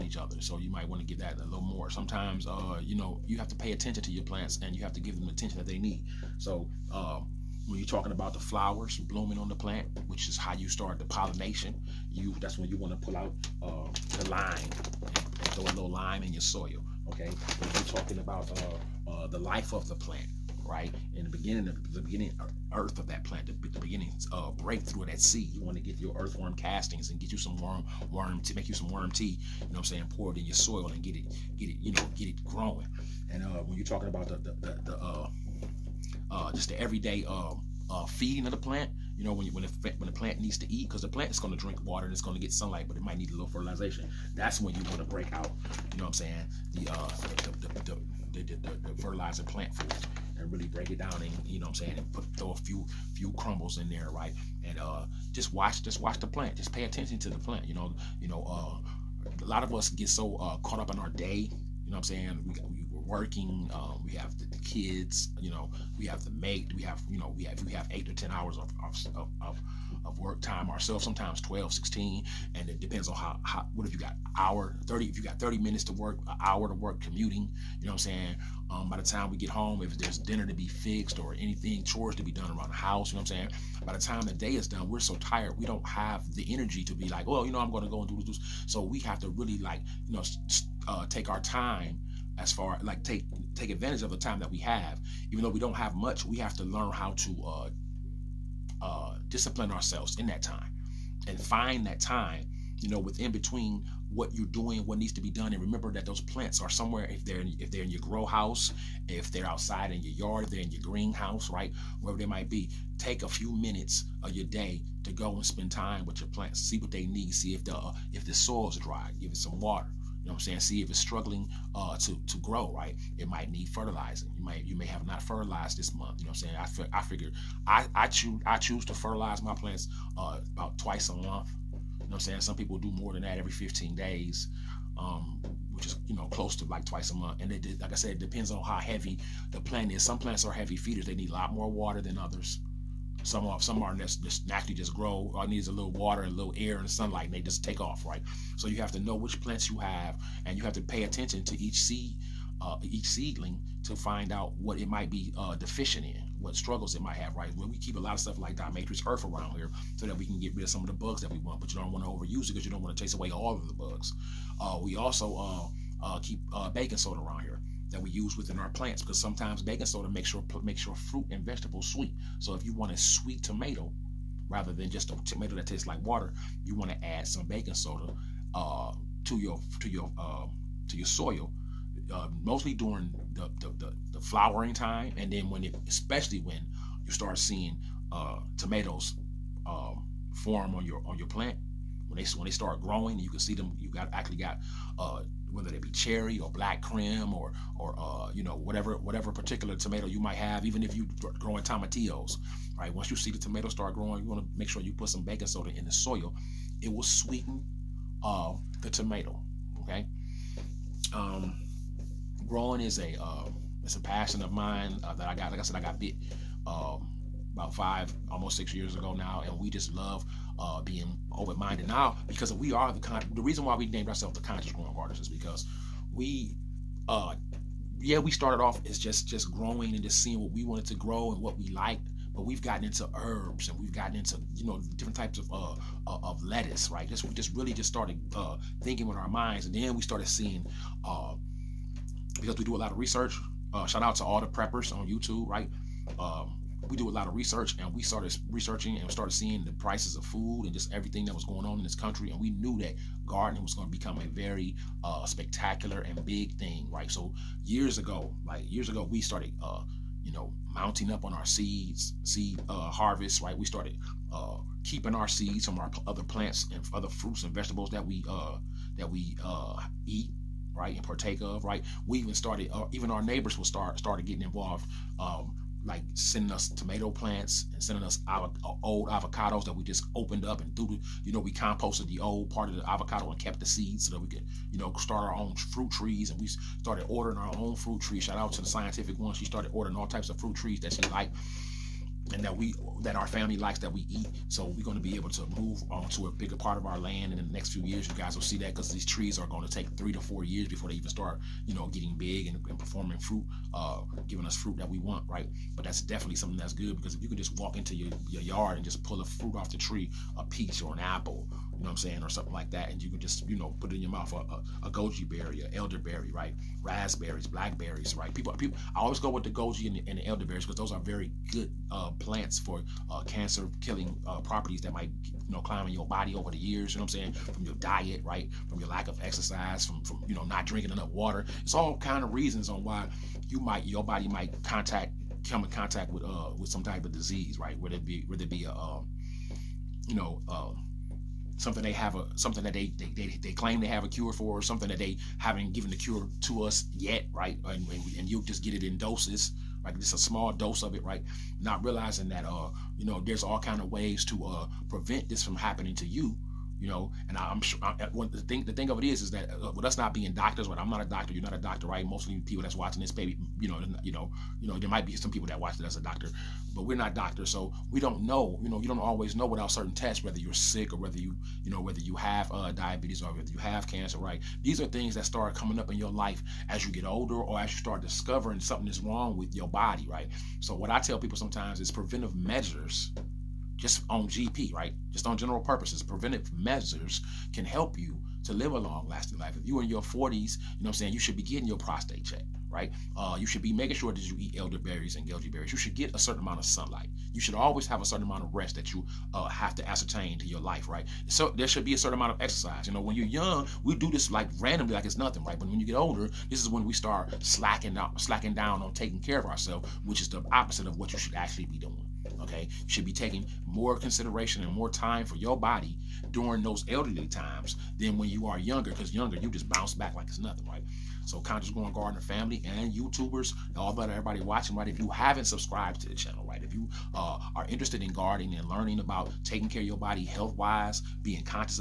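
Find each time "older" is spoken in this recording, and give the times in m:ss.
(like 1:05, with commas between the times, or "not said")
6:17, 6:45.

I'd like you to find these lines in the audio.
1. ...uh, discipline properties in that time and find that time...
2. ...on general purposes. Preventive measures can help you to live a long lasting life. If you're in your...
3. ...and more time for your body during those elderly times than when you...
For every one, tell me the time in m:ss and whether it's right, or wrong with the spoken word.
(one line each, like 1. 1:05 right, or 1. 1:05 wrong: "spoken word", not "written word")
1. 1:38 wrong: "ourselves", not "properties"
2. 6:25 right
3. 6:54 right.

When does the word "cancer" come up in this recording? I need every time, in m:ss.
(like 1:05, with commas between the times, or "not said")
5:23, 6:13.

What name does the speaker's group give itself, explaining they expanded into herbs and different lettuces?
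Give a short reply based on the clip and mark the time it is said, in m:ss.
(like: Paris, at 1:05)
Conscious Growing Artists, at 3:44.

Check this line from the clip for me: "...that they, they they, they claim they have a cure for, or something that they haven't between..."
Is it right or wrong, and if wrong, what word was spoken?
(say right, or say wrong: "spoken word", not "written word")
wrong: "given", not "between".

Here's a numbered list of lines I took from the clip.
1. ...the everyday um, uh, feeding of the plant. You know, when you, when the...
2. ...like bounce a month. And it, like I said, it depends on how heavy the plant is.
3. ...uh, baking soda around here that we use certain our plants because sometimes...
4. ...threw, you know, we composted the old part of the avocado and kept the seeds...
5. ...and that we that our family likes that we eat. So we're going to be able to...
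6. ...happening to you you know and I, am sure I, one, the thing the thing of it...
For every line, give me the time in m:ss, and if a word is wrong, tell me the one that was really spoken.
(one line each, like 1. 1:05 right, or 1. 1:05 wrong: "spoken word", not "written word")
1. 0:36 right
2. 2:16 wrong: "twice", not "bounce"
3. 2:46 wrong: "within", not "certain"
4. 4:40 right
5. 4:52 right
6. 5:55 right.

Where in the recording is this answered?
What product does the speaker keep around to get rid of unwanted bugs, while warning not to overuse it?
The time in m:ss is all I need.
2:38.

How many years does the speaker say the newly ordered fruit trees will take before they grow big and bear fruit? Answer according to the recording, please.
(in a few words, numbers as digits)
3 to 4 years.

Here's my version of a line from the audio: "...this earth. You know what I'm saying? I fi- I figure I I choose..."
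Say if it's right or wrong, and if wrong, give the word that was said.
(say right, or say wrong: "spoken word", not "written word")
wrong: "month", not "earth".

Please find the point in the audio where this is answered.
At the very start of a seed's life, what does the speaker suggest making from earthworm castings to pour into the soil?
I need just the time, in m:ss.
0:28.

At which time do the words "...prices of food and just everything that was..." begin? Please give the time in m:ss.
4:09.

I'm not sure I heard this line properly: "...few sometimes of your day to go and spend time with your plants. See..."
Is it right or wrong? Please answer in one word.
wrong.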